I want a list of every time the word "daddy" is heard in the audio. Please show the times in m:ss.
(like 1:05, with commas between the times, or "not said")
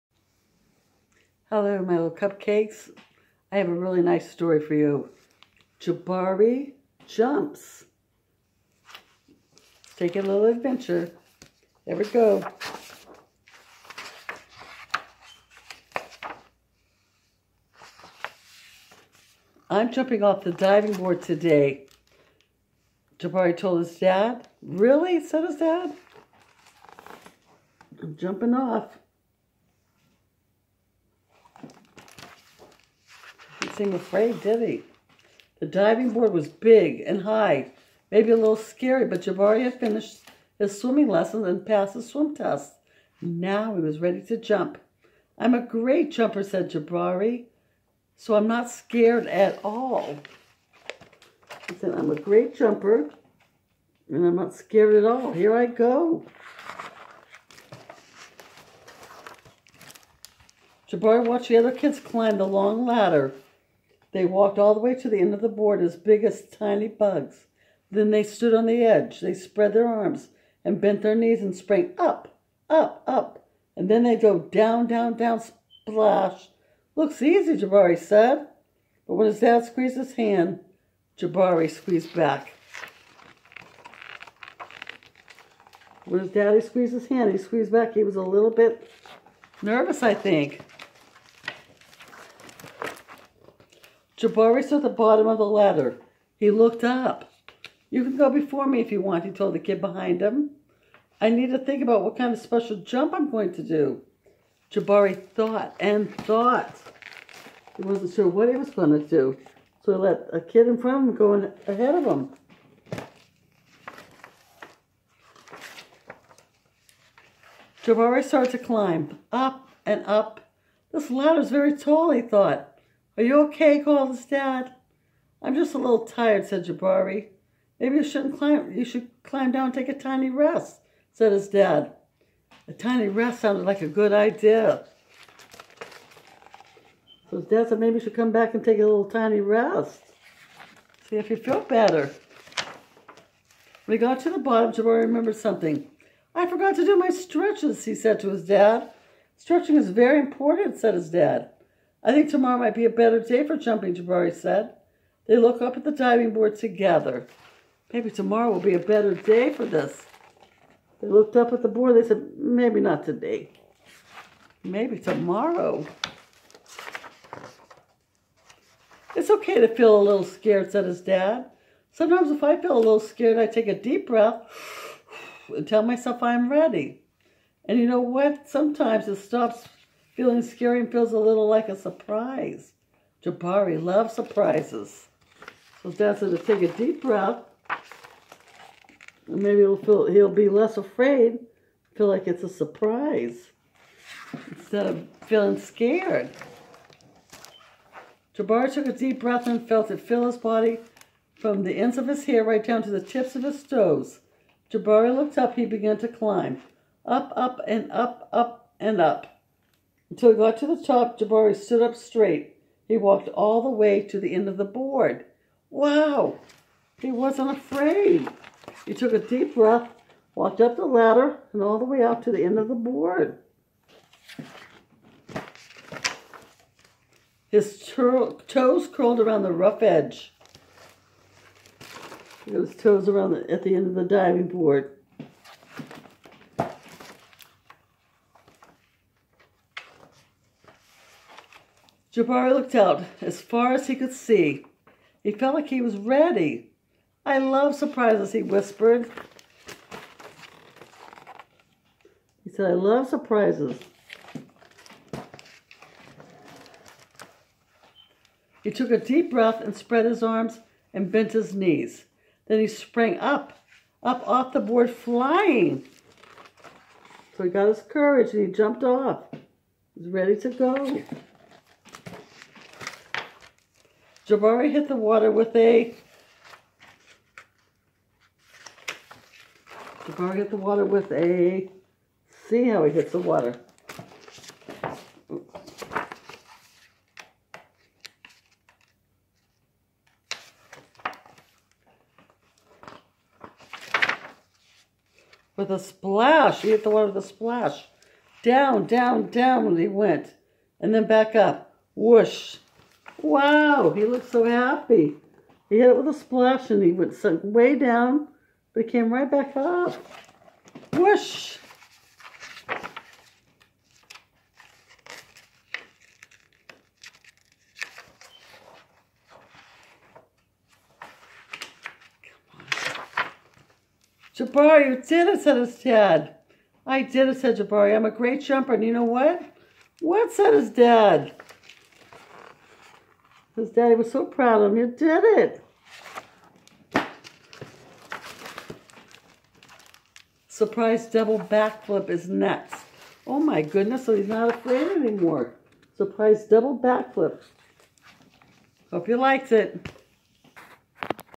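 1:26, 5:33.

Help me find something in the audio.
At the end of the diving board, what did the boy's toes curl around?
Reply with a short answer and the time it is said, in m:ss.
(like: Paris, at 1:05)
The rough edge, at 3:49.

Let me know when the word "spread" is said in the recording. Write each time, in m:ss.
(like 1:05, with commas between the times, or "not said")
1:09, 4:19.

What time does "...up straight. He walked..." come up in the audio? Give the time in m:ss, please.
3:31.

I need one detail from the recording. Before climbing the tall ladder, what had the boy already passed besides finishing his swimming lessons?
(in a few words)
The swim test.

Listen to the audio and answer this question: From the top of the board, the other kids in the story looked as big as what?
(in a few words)
Tiny bugs.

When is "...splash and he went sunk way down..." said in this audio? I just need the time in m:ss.
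5:06.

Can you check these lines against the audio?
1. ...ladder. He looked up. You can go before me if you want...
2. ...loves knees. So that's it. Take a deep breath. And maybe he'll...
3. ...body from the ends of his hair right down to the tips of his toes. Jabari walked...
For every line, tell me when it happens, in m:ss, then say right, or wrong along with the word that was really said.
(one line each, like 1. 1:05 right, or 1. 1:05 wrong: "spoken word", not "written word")
1. 1:35 right
2. 3:03 wrong: "surprises", not "knees"
3. 3:20 wrong: "looked", not "walked".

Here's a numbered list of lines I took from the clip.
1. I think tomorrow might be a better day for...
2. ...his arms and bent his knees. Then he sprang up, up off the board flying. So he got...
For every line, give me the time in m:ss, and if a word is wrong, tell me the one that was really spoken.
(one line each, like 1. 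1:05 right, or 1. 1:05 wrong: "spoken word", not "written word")
1. 2:32 right
2. 4:20 right.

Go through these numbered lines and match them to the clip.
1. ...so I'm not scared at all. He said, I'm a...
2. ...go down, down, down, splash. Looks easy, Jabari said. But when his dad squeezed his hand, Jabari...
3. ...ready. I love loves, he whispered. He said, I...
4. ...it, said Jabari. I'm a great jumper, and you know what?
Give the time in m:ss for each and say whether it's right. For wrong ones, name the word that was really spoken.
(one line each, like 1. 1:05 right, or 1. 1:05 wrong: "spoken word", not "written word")
1. 0:48 right
2. 1:14 right
3. 4:05 wrong: "surprises", not "loves"
4. 5:27 right.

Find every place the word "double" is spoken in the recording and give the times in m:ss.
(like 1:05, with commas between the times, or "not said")
5:41, 5:46.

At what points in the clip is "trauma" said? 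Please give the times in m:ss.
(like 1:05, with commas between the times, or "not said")
not said.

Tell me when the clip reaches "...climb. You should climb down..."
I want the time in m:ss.
2:08.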